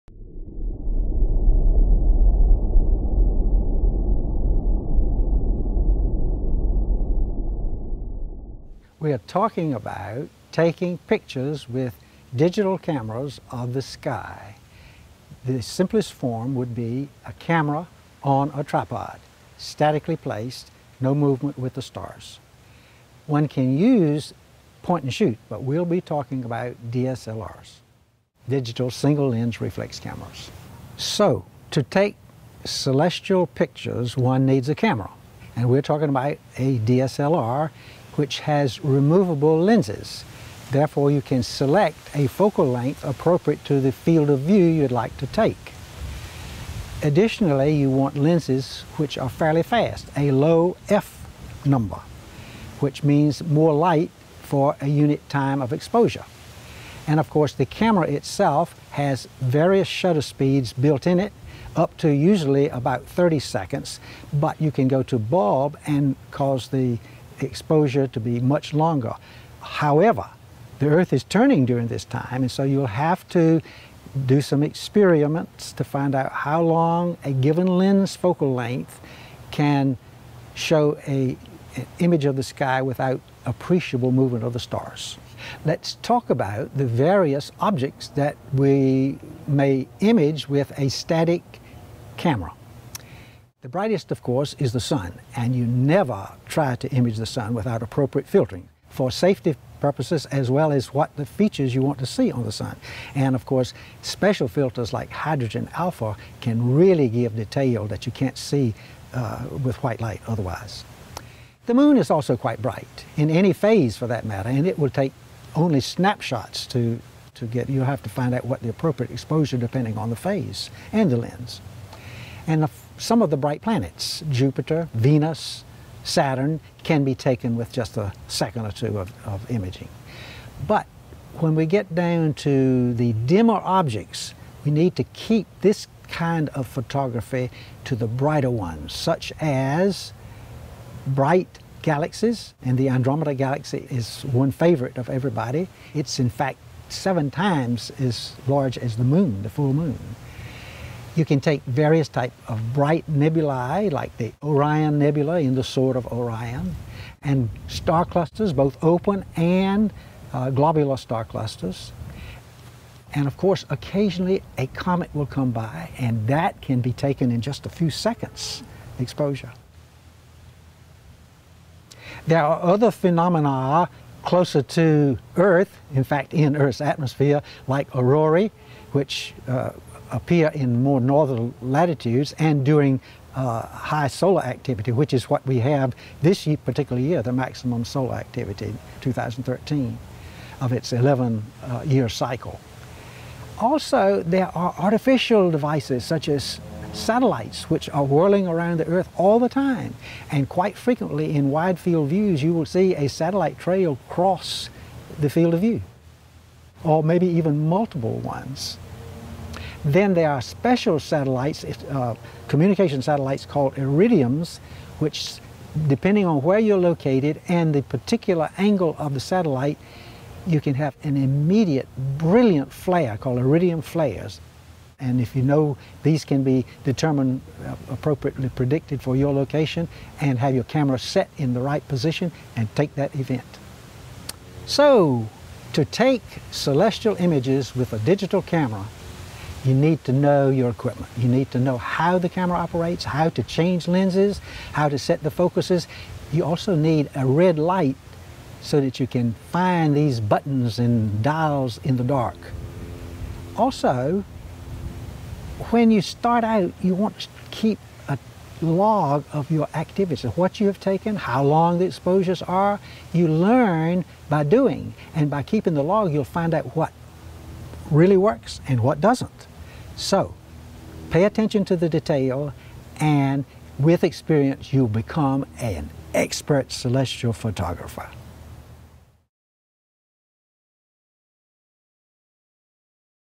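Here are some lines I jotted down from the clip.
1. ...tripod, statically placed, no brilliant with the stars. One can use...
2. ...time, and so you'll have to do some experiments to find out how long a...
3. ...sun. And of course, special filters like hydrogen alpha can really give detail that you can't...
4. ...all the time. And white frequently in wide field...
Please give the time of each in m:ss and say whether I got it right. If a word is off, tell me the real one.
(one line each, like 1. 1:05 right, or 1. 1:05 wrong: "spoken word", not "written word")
1. 0:18 wrong: "movement", not "brilliant"
2. 1:12 right
3. 1:42 right
4. 3:19 wrong: "quite", not "white".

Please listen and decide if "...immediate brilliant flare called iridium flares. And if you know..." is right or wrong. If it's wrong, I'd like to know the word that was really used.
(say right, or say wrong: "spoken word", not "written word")
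right.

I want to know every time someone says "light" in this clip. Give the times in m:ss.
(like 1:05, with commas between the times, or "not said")
0:53, 1:50, 4:07.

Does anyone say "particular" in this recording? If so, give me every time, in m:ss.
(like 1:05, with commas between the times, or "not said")
3:06, 3:37.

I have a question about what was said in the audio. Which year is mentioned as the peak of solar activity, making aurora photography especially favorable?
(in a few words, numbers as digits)
2013.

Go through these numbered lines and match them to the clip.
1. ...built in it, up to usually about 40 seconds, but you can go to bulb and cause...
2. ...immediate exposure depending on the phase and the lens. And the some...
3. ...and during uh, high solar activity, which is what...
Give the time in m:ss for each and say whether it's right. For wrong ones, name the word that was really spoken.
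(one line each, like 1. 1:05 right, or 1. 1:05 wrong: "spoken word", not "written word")
1. 1:00 wrong: "30", not "40"
2. 1:58 wrong: "appropriate", not "immediate"
3. 3:02 right.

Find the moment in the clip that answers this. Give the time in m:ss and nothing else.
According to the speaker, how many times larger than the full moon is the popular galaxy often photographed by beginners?
2:26.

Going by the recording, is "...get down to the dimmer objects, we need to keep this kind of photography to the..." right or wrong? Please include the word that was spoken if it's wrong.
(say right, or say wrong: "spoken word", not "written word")
right.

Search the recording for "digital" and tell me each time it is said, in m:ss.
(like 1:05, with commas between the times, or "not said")
0:12, 0:28, 3:57.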